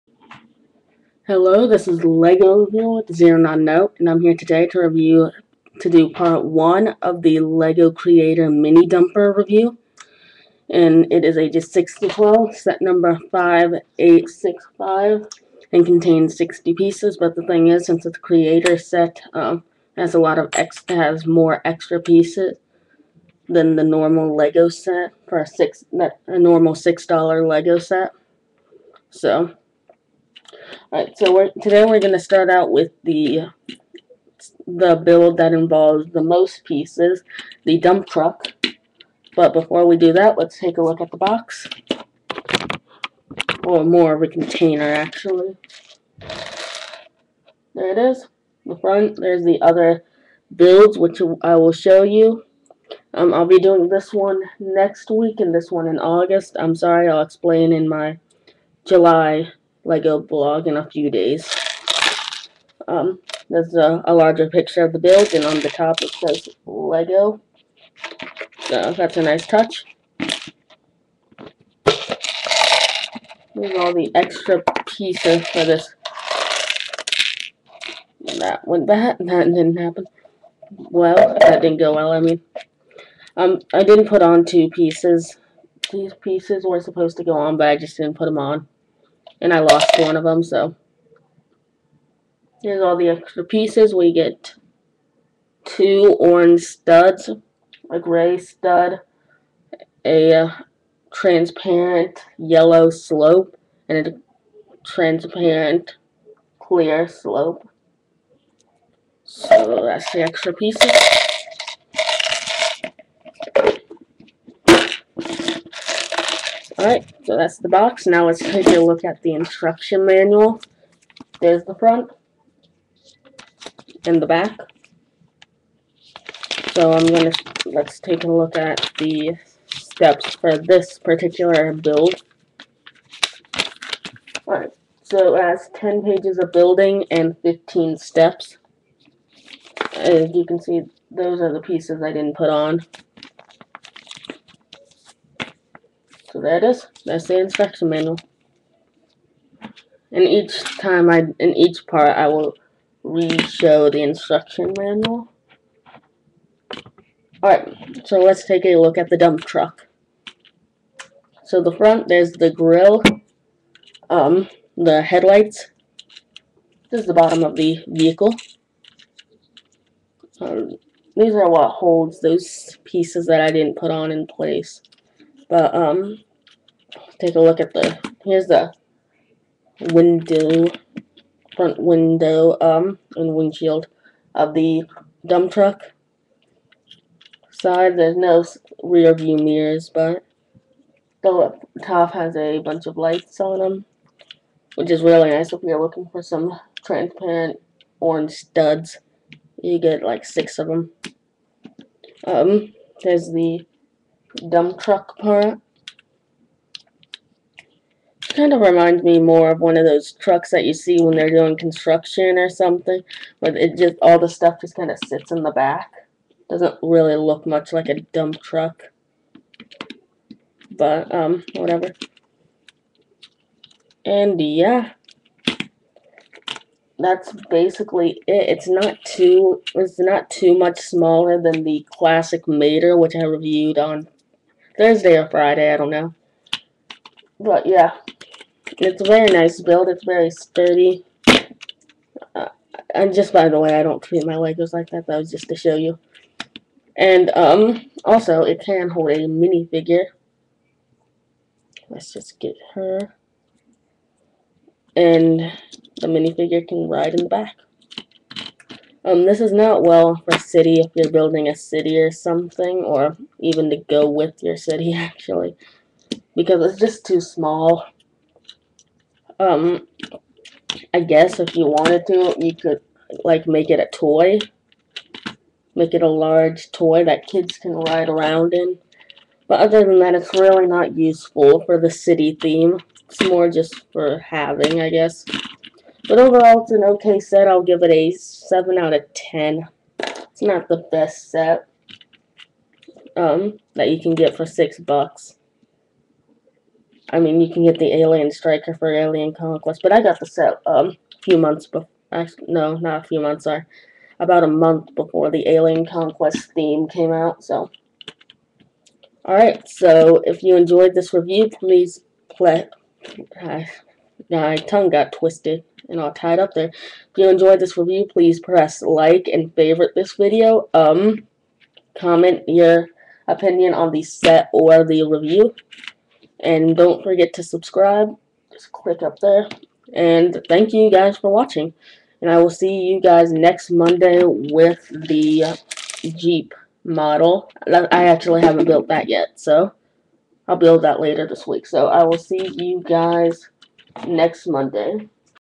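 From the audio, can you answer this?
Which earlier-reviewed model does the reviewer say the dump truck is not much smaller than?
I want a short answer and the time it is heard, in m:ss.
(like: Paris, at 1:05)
Classic Mater, at 3:51.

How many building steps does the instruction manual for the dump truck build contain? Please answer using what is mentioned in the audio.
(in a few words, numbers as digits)
15.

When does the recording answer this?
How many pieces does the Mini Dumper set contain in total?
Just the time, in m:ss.
0:16.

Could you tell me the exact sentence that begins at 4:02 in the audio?
Uh, and just by the way, I don't treat my Legos like that.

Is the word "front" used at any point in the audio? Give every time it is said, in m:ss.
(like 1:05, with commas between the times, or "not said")
0:48, 2:01, 2:41, 3:01.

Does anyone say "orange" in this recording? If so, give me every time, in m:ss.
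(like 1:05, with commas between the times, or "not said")
1:36, 3:17.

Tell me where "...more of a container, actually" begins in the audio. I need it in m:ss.
0:43.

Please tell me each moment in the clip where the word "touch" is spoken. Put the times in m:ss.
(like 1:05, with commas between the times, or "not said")
1:09.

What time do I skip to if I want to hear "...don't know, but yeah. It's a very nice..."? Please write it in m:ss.
3:55.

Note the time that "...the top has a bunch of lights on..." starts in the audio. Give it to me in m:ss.
3:11.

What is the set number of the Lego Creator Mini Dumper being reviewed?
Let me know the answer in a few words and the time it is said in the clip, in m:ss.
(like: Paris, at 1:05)
5865, at 0:12.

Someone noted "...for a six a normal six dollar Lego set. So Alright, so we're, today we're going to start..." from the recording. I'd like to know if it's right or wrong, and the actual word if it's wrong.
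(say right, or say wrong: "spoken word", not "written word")
right.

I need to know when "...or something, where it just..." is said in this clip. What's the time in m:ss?
3:32.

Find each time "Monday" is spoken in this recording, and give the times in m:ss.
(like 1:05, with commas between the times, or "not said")
5:33, 5:44.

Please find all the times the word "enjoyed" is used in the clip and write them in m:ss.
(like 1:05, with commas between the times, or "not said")
5:10, 5:17.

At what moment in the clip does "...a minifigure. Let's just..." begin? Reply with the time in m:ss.
4:09.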